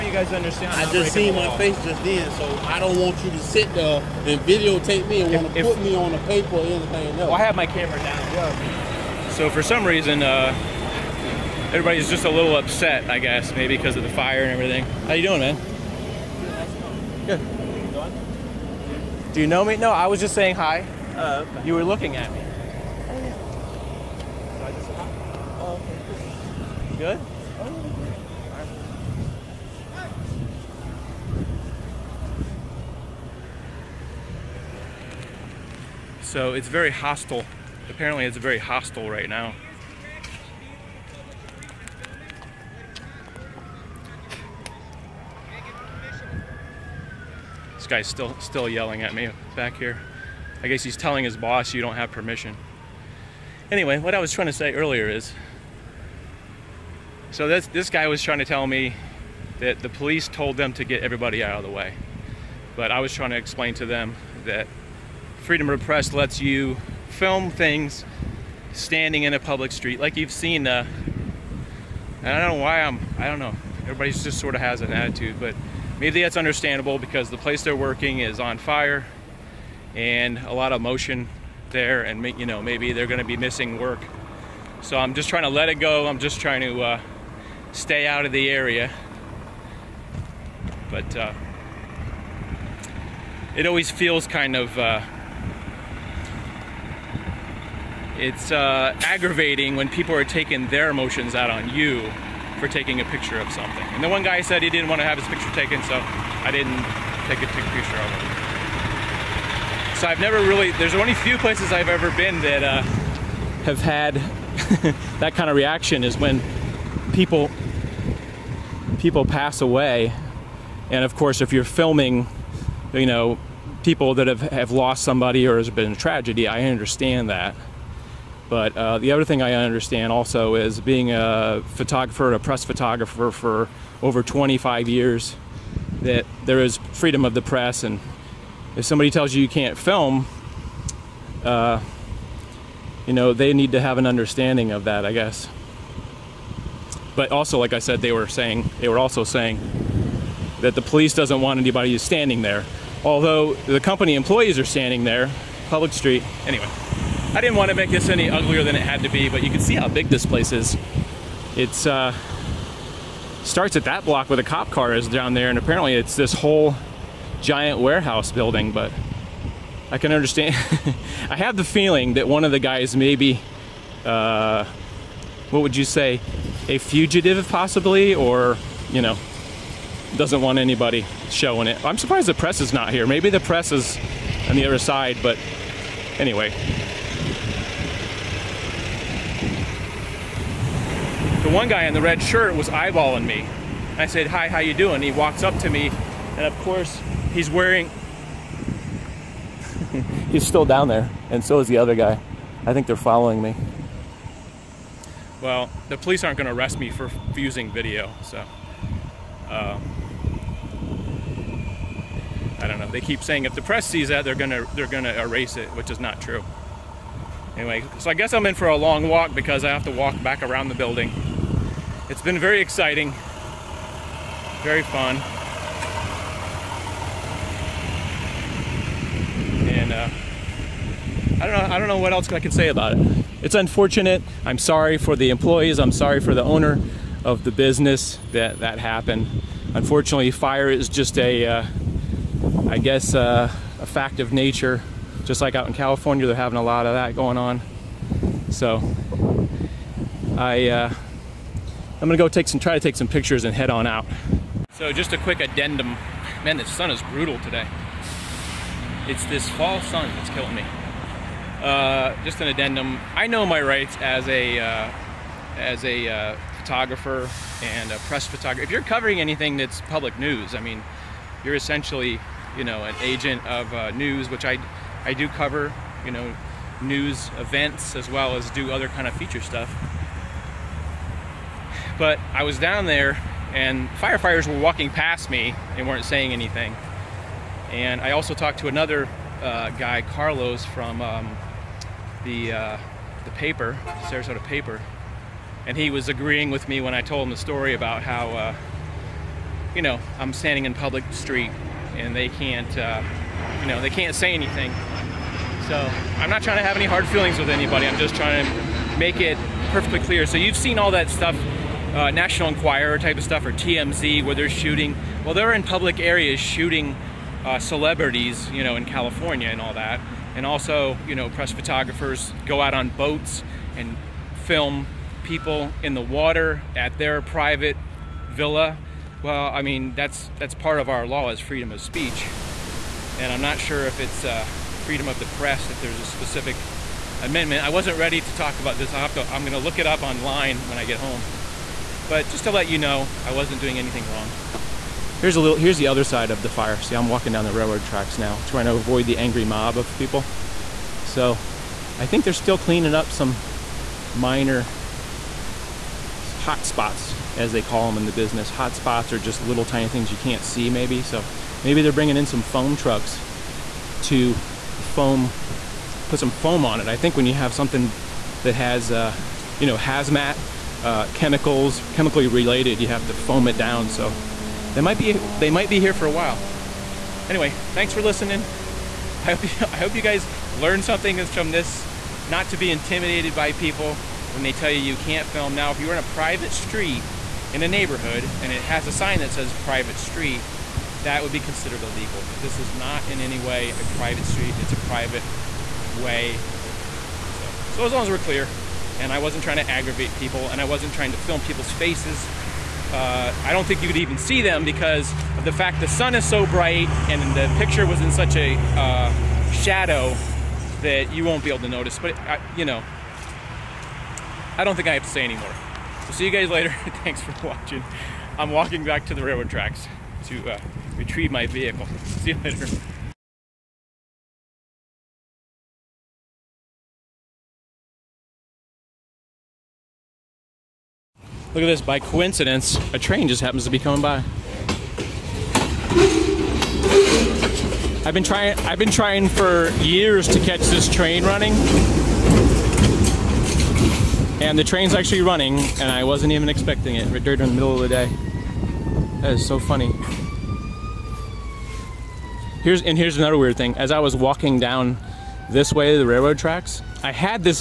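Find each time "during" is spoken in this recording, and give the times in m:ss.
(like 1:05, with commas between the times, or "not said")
7:27.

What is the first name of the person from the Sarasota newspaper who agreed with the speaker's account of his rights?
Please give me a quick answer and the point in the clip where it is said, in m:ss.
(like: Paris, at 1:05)
Carlos, at 4:50.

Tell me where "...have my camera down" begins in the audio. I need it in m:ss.
0:07.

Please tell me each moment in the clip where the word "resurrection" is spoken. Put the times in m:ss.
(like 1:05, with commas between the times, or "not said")
not said.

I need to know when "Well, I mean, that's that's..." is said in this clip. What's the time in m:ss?
5:29.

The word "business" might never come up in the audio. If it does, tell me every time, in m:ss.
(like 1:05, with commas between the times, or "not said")
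3:57, 5:58.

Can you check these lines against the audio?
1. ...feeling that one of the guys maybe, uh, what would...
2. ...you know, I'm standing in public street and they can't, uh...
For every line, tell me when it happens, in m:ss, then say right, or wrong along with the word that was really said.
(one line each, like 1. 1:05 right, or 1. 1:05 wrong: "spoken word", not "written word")
1. 2:51 right
2. 4:59 right.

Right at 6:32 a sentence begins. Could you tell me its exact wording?
But this is not in any way a private street.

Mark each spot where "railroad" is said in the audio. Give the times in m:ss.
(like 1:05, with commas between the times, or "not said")
5:47, 6:59, 7:36.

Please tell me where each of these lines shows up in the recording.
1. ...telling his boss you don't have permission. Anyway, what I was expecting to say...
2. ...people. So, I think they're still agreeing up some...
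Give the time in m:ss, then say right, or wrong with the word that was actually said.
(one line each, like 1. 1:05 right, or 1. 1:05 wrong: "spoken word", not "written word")
1. 0:50 wrong: "trying", not "expecting"
2. 5:49 wrong: "cleaning", not "agreeing".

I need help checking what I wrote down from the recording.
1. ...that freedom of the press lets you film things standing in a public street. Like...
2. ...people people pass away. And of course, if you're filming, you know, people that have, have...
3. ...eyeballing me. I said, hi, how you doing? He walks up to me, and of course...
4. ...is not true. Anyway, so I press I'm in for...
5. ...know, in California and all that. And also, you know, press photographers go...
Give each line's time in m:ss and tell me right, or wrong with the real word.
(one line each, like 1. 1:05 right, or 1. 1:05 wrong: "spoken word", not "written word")
1. 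1:04 right
2. 1:57 right
3. 3:12 right
4. 3:35 wrong: "guess", not "press"
5. 5:18 right.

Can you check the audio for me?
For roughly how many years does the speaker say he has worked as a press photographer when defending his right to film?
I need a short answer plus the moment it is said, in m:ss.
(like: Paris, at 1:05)
over 25 years, at 2:14.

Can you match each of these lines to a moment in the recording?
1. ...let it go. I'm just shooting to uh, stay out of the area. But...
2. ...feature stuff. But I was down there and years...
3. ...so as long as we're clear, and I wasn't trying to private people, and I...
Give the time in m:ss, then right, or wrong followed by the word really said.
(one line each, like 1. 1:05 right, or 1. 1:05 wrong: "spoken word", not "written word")
1. 1:25 wrong: "trying", not "shooting"
2. 4:39 wrong: "firefighters", not "years"
3. 6:37 wrong: "aggravate", not "private".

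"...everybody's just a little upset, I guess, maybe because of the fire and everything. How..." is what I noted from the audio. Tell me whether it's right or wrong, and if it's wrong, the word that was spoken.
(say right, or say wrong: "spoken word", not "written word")
right.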